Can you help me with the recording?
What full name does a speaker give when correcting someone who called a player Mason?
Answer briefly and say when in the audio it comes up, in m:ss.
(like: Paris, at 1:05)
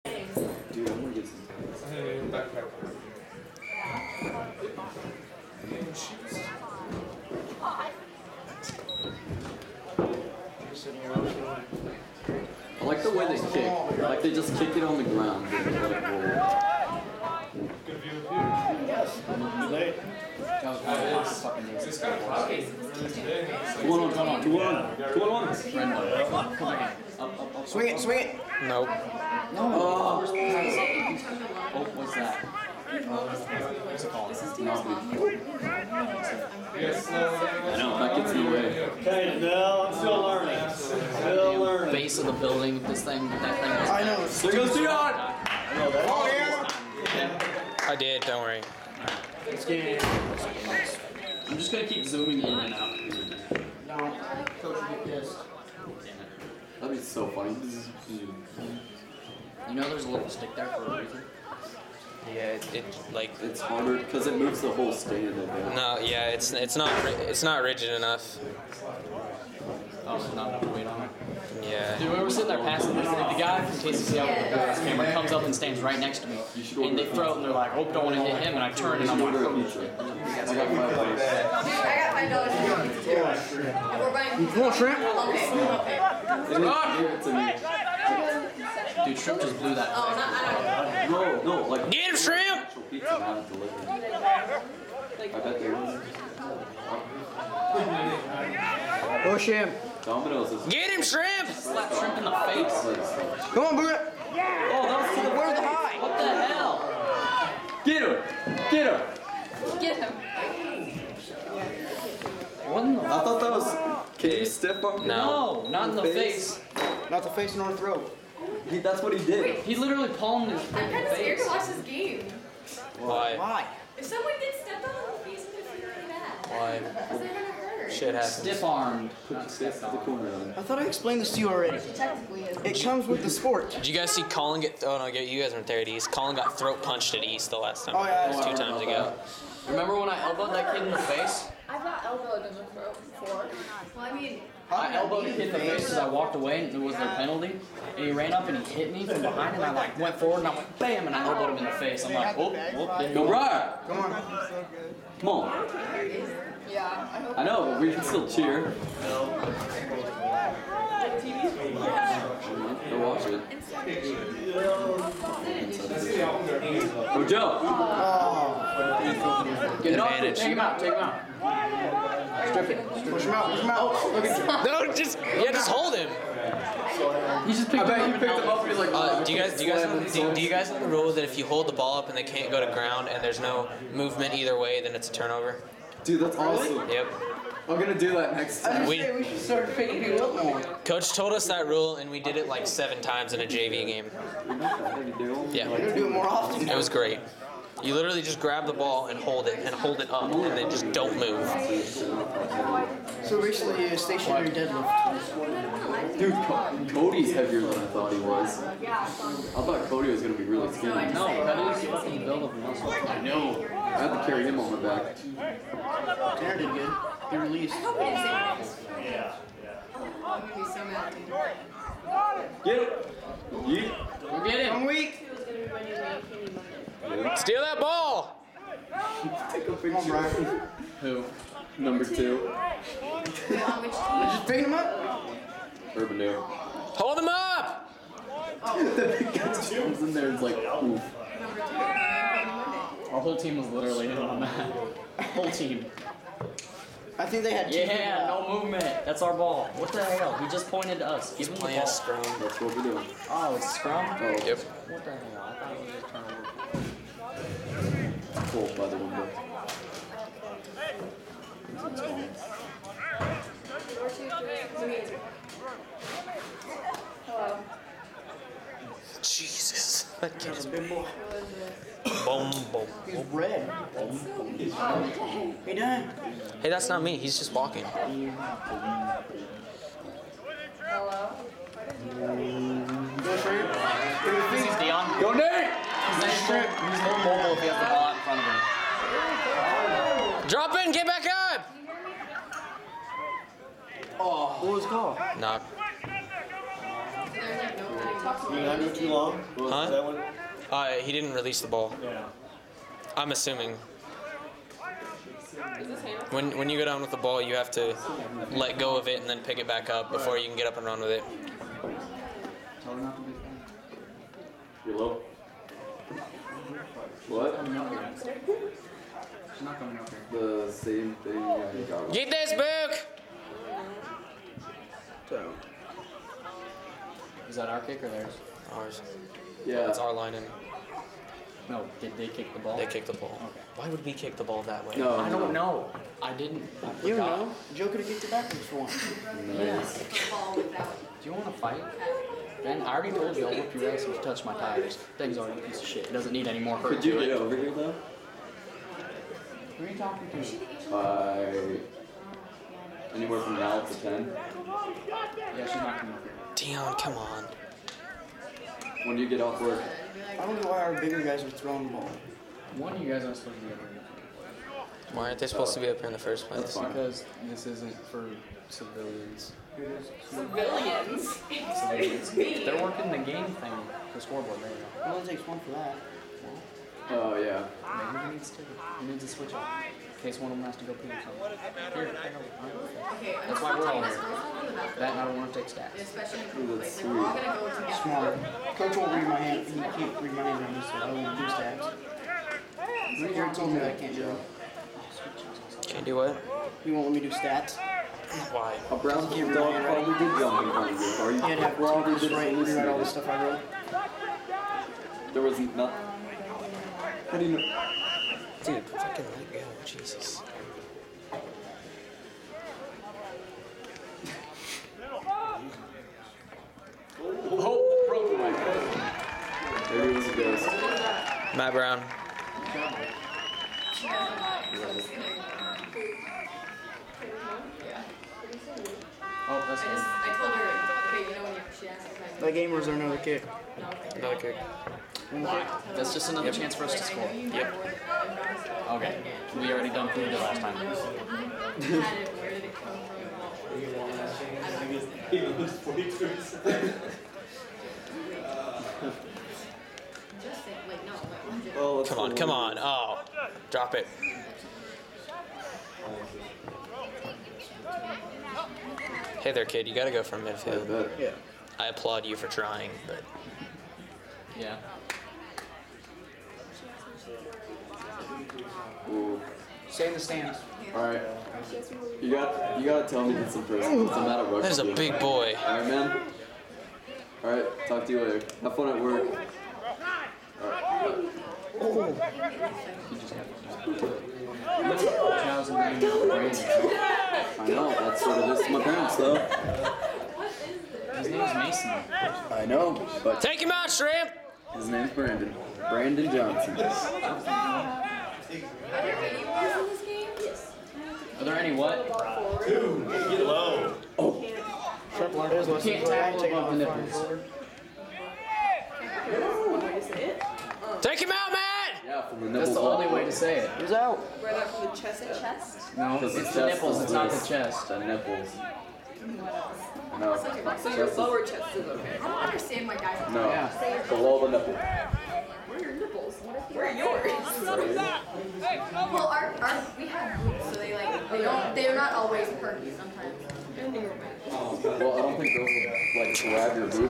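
Brandon Johnson, at 8:15.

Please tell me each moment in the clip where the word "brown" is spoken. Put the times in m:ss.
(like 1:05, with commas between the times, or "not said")
6:38, 7:01.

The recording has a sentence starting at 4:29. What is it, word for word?
Jesus, that Boom, boom, He's red.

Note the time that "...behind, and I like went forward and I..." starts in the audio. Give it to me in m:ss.
2:29.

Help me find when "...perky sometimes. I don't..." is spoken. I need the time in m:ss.
8:52.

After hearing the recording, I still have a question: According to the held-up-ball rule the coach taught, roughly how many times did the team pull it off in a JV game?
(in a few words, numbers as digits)
7.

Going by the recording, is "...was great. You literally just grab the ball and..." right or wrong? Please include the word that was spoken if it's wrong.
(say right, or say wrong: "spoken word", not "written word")
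right.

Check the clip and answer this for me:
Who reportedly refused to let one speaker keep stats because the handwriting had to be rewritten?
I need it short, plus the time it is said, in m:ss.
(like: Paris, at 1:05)
Richard, at 6:33.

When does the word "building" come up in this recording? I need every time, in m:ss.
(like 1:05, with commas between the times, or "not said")
0:42.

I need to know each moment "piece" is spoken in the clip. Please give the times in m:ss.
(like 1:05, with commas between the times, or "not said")
5:45.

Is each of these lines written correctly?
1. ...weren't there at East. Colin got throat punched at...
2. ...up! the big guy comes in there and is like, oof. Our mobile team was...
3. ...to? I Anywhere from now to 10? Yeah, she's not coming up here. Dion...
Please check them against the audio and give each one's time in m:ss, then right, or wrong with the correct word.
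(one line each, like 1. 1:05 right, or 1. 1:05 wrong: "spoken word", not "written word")
1. 2:15 right
2. 3:57 wrong: "whole", not "mobile"
3. 5:50 right.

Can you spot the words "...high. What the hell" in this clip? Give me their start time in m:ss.
1:45.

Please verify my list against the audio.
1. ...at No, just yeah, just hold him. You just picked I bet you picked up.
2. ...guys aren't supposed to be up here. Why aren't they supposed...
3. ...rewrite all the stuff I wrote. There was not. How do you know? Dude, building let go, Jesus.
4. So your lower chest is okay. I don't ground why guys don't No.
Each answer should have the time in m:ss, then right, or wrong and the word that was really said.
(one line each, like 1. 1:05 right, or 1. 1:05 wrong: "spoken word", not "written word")
1. 2:54 right
2. 6:03 right
3. 6:42 wrong: "fucking", not "building"
4. 8:40 wrong: "understand", not "ground".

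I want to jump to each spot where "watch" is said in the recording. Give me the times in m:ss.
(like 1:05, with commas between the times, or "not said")
2:01, 2:42.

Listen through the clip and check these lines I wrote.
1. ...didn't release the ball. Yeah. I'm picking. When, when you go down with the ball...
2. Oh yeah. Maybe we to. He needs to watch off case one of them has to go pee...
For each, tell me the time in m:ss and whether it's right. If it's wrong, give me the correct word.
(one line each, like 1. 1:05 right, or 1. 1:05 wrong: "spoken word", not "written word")
1. 5:01 wrong: "assuming", not "picking"
2. 6:17 wrong: "switch", not "watch".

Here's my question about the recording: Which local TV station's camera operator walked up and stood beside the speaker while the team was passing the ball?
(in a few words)
KCCI.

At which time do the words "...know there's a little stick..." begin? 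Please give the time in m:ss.
0:59.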